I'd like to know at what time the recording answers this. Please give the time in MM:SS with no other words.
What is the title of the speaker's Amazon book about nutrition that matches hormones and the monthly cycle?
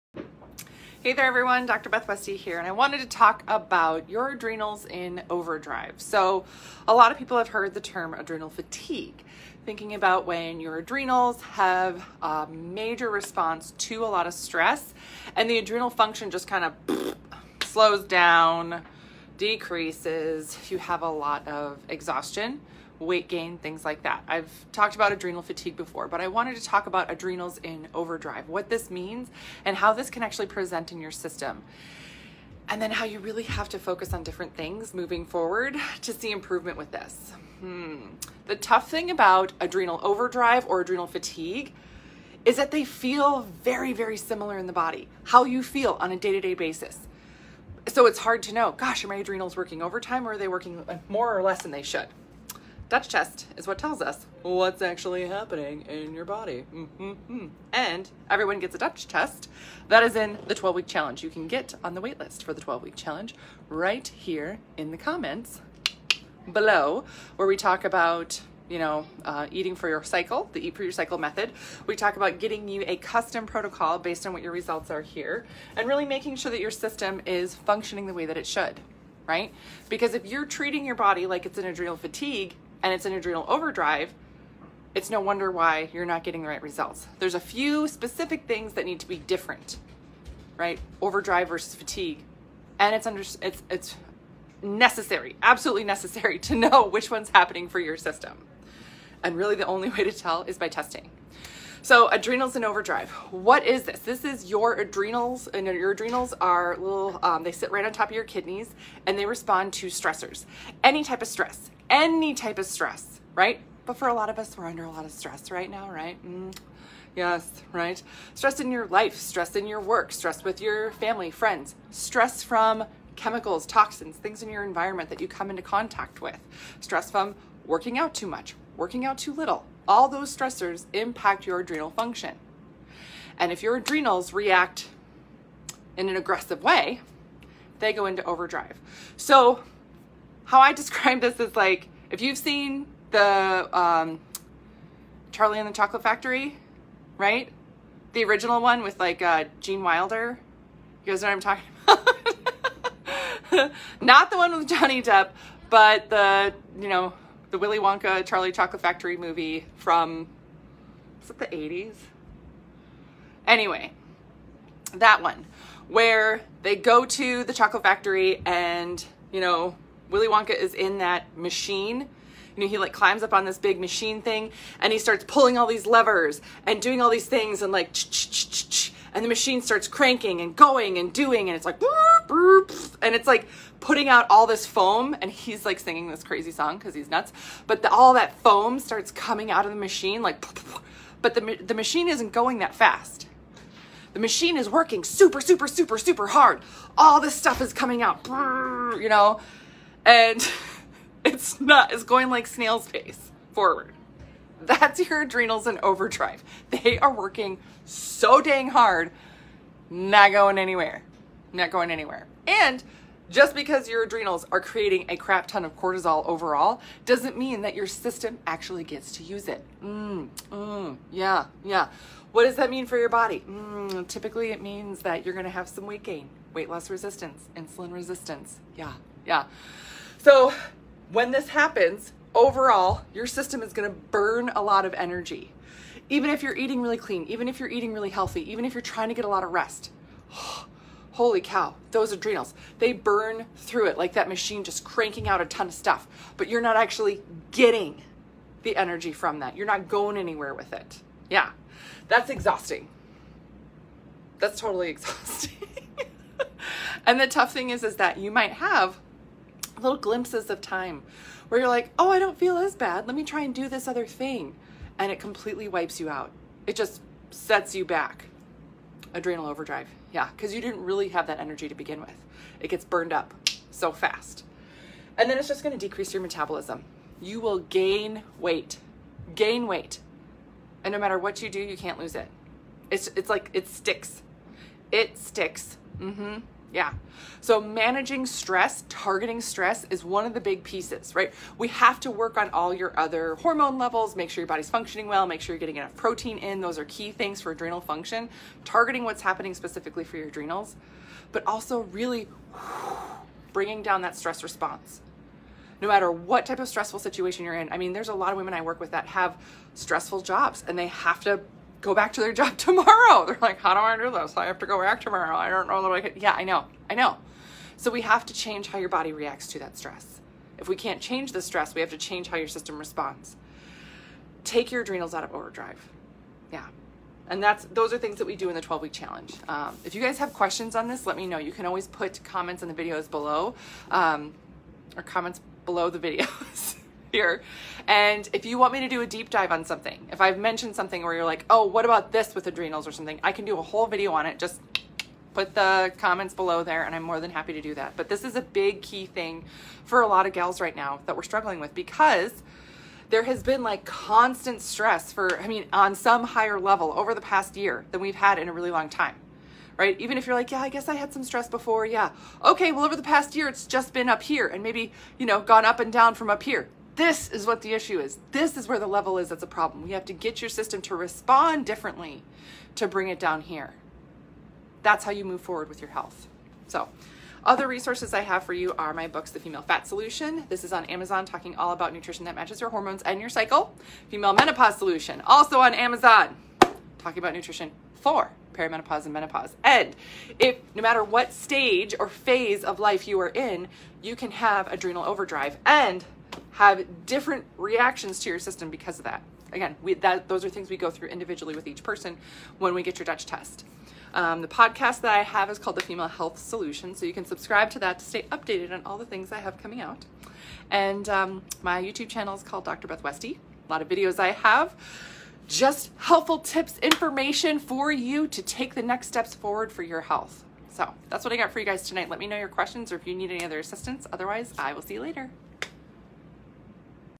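06:19.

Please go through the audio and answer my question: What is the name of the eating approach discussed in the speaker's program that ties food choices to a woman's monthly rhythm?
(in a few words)
Eat for Your Cycle.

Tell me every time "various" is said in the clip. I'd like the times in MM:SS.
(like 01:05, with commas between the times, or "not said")
not said.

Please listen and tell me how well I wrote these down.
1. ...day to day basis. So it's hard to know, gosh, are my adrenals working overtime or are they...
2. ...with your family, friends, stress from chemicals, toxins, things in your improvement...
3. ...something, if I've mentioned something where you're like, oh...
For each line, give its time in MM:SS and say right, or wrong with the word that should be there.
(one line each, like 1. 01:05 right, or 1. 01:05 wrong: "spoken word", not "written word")
1. 00:46 right
2. 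02:00 wrong: "environment", not "improvement"
3. 05:39 right.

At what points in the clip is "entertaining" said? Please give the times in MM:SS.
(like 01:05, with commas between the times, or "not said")
not said.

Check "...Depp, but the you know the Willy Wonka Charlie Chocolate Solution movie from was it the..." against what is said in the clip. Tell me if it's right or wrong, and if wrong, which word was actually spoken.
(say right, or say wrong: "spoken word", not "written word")
wrong: "Factory", not "Solution".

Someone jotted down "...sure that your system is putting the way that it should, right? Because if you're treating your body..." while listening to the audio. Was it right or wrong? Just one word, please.
wrong.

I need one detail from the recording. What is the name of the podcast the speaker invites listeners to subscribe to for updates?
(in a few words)
The Female Health Solution.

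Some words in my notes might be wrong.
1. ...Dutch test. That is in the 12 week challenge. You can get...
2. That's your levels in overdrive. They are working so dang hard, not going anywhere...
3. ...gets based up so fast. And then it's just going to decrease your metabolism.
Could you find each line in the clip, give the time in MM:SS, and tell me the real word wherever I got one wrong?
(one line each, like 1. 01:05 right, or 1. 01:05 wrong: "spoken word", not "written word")
1. 00:58 right
2. 03:24 wrong: "adrenals", not "levels"
3. 04:32 wrong: "burned", not "based".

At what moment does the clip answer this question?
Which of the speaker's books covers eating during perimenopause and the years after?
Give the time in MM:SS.
06:24.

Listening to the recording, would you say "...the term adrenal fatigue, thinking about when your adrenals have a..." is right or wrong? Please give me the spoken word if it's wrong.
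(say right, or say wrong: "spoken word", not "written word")
right.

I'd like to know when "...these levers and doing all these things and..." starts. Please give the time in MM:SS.
02:55.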